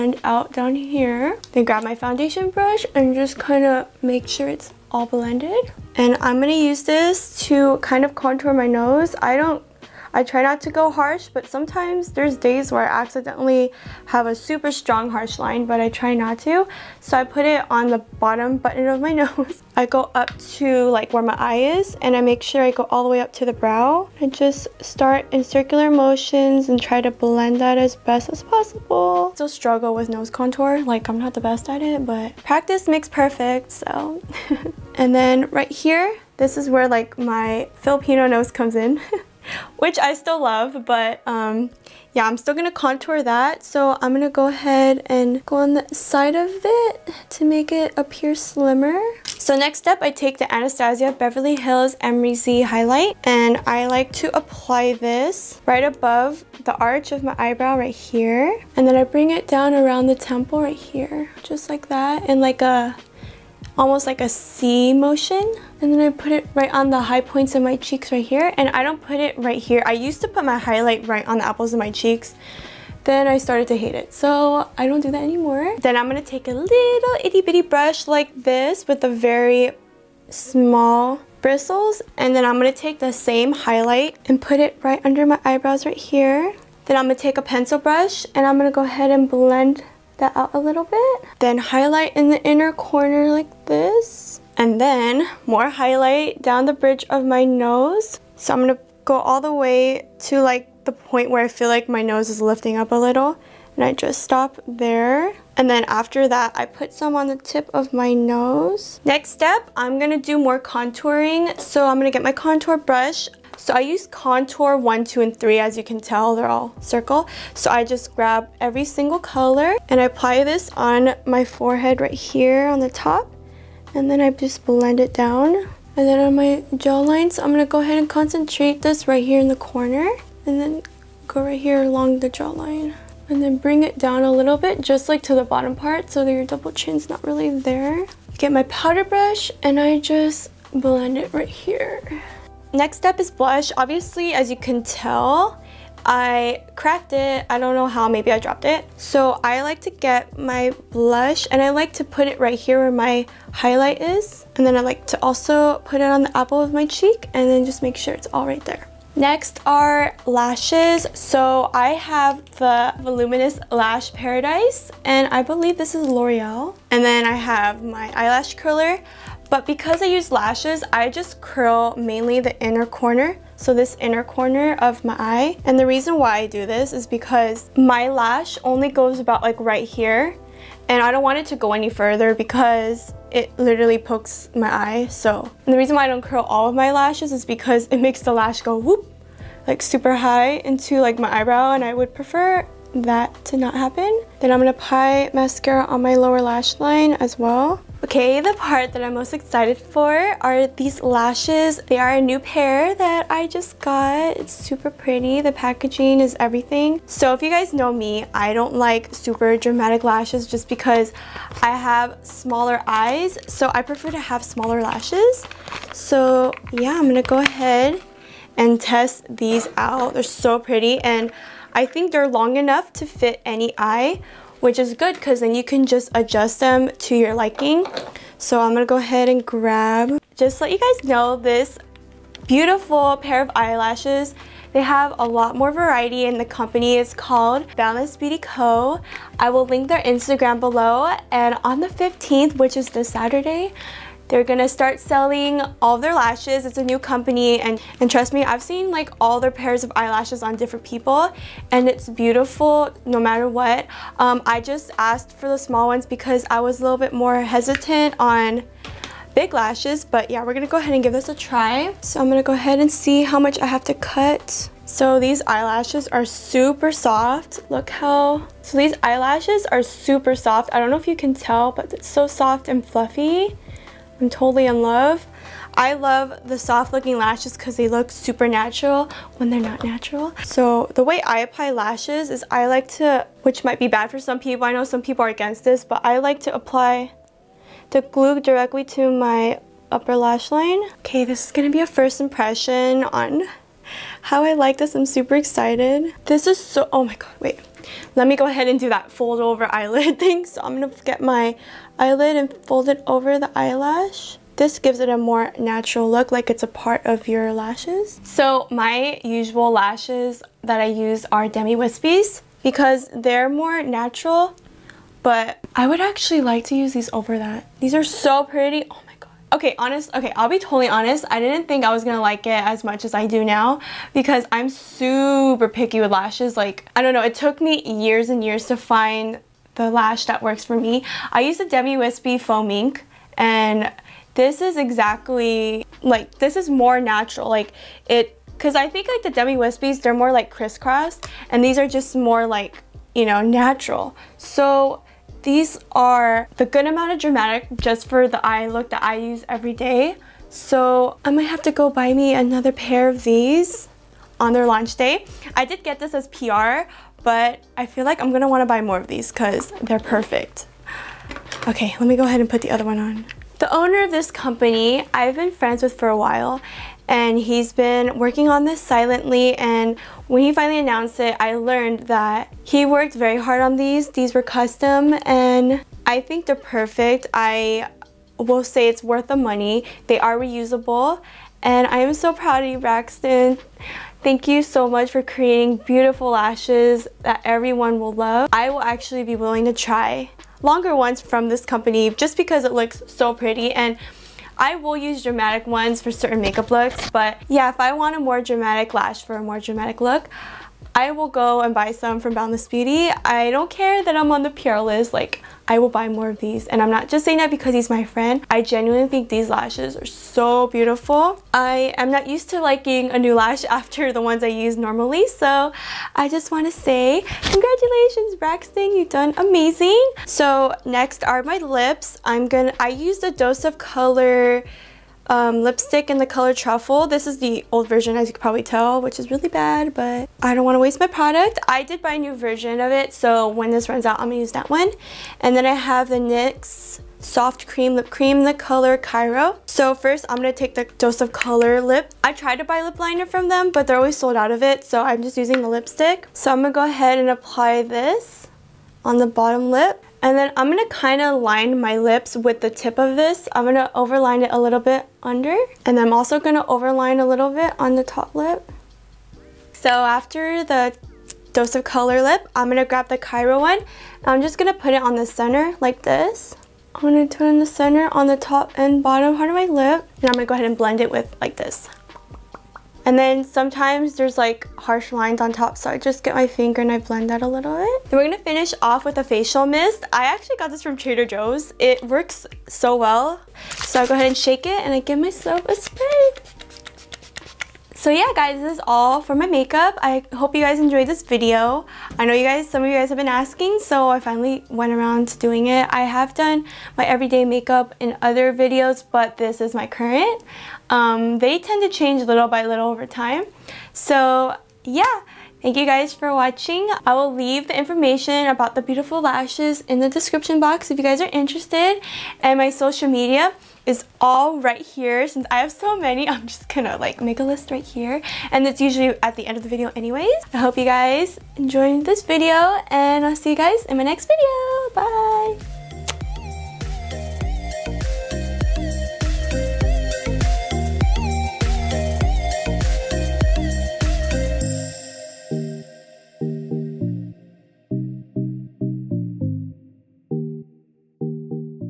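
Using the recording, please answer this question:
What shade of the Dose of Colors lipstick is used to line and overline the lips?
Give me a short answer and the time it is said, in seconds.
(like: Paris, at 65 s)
Truffle, at 426 s.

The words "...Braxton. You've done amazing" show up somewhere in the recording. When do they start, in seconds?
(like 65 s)
418 s.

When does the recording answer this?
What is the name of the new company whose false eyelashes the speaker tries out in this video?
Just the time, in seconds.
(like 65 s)
237 s.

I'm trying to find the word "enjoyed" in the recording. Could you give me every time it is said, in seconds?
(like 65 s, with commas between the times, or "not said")
490 s, 521 s.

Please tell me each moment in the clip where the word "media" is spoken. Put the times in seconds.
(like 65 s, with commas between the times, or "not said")
513 s.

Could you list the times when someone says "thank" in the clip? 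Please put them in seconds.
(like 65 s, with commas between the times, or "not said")
384 s, 505 s.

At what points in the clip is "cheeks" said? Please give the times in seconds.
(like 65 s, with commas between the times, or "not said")
67 s, 71 s, 156 s.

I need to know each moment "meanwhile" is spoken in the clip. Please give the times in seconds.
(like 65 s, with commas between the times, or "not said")
not said.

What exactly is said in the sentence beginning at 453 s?
I'm gonna overline it a little bit under.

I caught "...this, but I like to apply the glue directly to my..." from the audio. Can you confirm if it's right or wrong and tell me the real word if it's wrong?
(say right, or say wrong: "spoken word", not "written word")
right.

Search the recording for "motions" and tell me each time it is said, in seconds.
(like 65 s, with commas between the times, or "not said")
25 s, 64 s.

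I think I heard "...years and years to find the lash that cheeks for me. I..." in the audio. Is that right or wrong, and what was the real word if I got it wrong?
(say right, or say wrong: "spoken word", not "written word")
wrong: "works", not "cheeks".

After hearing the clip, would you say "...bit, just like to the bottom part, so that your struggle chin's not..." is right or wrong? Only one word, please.
wrong.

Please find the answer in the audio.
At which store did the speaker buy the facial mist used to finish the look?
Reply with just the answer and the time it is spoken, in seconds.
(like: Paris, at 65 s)
Trader Joe's, at 480 s.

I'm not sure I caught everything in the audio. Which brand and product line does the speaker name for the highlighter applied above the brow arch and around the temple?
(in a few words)
Anastasia Beverly Hills Amrezy.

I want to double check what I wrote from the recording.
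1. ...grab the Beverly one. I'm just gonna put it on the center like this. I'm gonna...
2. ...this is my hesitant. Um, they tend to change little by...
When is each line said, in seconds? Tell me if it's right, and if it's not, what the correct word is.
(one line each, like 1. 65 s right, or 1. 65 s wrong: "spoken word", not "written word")
1. 462 s wrong: "Cairo", not "Beverly"
2. 499 s wrong: "current", not "hesitant".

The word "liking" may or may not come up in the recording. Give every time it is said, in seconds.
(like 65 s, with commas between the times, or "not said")
227 s, 412 s.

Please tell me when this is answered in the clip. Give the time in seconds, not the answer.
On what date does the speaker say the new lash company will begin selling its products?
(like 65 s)
241 s.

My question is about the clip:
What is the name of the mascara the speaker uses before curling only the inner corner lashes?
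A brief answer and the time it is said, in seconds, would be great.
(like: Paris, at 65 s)
Voluminous Lash Paradise, at 163 s.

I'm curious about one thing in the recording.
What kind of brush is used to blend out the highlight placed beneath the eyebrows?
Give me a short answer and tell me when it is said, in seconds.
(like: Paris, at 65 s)
pencil brush, at 87 s.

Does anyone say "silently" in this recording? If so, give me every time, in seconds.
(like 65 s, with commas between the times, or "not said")
368 s.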